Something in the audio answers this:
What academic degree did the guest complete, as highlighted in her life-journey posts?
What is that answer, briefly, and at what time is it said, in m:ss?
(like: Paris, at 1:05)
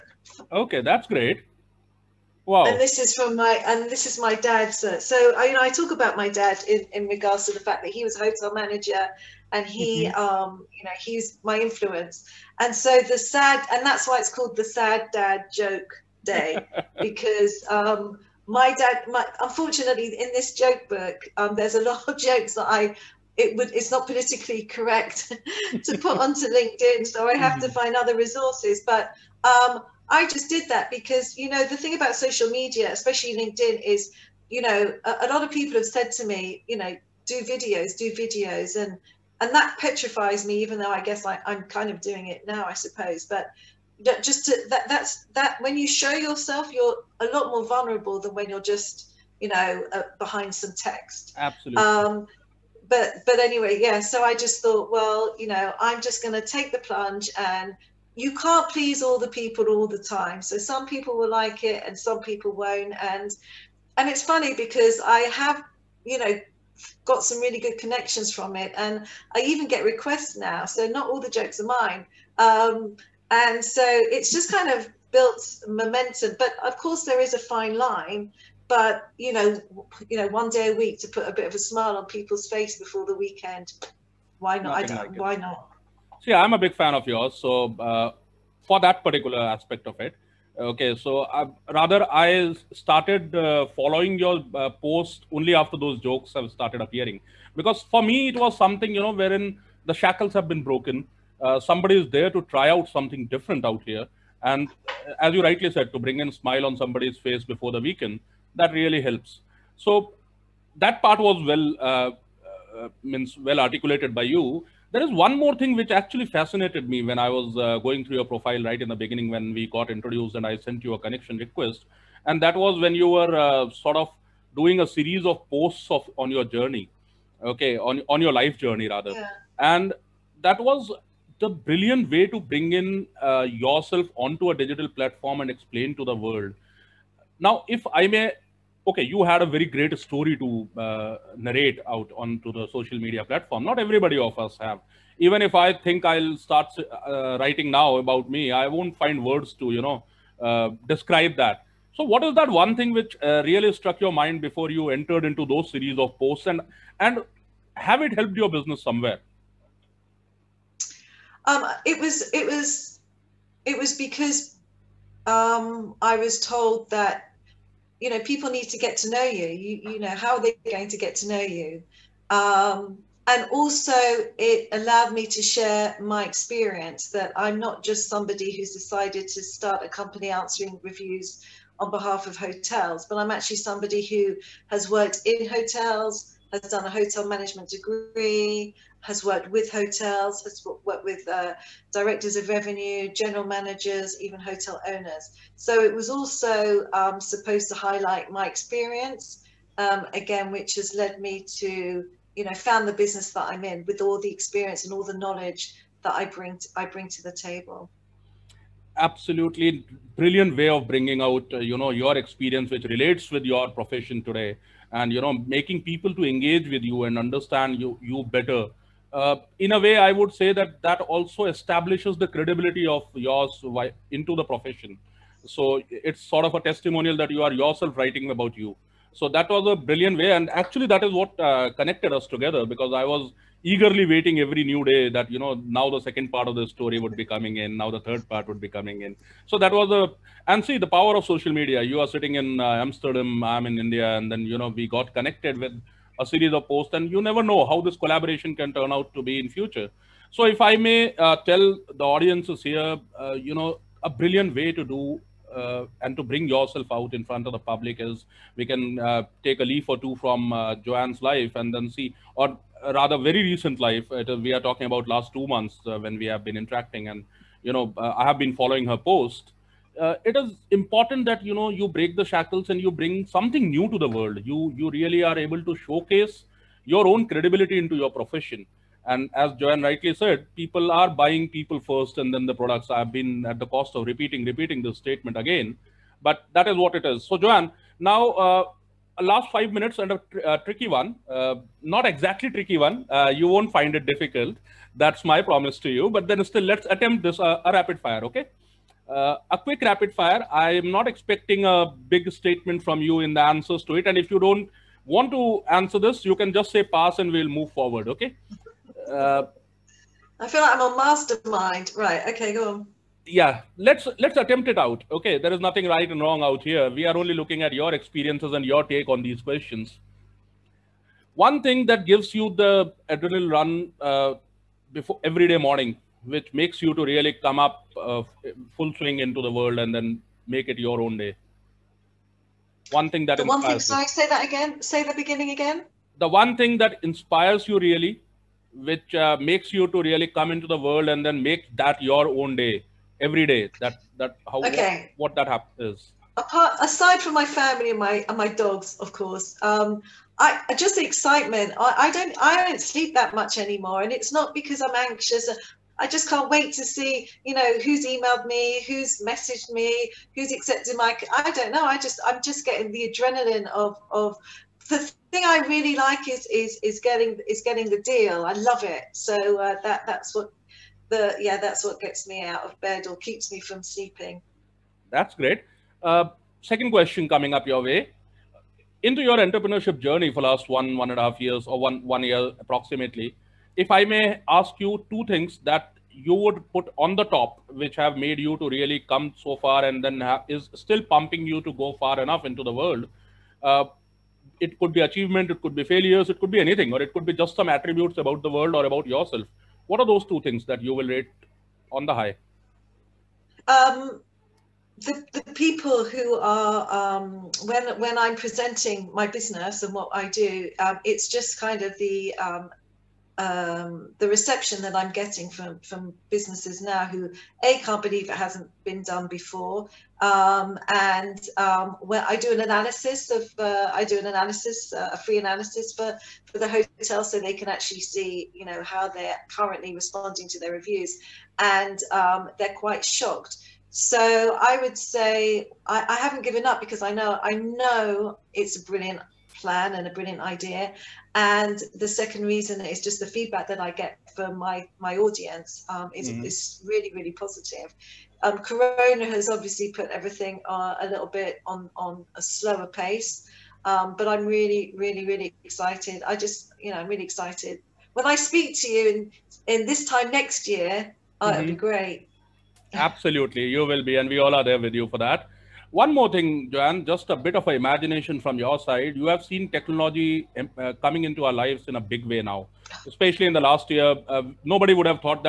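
Hotel management degree, at 3:06.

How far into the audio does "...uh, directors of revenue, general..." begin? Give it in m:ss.
3:11.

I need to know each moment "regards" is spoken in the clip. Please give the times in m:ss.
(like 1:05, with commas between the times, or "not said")
0:07.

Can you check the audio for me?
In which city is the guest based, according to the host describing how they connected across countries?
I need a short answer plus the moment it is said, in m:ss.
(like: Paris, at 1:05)
Amsterdam, at 4:02.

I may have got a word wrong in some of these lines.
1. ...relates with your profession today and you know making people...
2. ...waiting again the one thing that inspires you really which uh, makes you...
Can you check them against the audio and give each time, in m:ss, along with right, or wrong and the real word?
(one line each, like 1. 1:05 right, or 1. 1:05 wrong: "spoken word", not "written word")
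1. 3:32 right
2. 5:35 wrong: "beginning", not "waiting".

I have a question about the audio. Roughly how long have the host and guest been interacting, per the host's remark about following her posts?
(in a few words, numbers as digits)
2 months.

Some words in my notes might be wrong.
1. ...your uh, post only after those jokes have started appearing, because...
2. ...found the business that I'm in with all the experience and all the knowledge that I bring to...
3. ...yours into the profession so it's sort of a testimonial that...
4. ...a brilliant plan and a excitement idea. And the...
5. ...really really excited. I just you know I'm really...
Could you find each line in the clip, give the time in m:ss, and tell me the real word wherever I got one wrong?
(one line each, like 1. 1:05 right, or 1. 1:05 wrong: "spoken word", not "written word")
1. 1:34 right
2. 3:22 right
3. 3:43 right
4. 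7:18 wrong: "brilliant", not "excitement"
5. 7:35 right.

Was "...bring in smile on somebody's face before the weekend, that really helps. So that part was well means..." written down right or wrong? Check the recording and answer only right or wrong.
right.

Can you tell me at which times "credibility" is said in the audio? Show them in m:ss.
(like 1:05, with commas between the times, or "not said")
3:42, 4:37.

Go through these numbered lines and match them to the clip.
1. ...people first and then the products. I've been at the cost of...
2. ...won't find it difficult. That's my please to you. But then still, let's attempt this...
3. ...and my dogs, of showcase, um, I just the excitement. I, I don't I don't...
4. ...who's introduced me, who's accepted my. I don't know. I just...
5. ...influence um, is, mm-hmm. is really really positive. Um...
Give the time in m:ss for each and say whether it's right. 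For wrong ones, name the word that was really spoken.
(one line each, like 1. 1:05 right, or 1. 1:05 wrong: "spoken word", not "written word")
1. 4:41 right
2. 4:53 wrong: "promise", not "please"
3. 5:48 wrong: "course", not "showcase"
4. 5:58 wrong: "messaged", not "introduced"
5. 7:25 wrong: "audience", not "influence".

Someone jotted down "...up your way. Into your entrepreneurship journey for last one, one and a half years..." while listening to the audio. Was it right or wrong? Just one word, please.
right.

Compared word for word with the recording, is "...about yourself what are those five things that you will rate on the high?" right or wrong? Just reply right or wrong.
wrong.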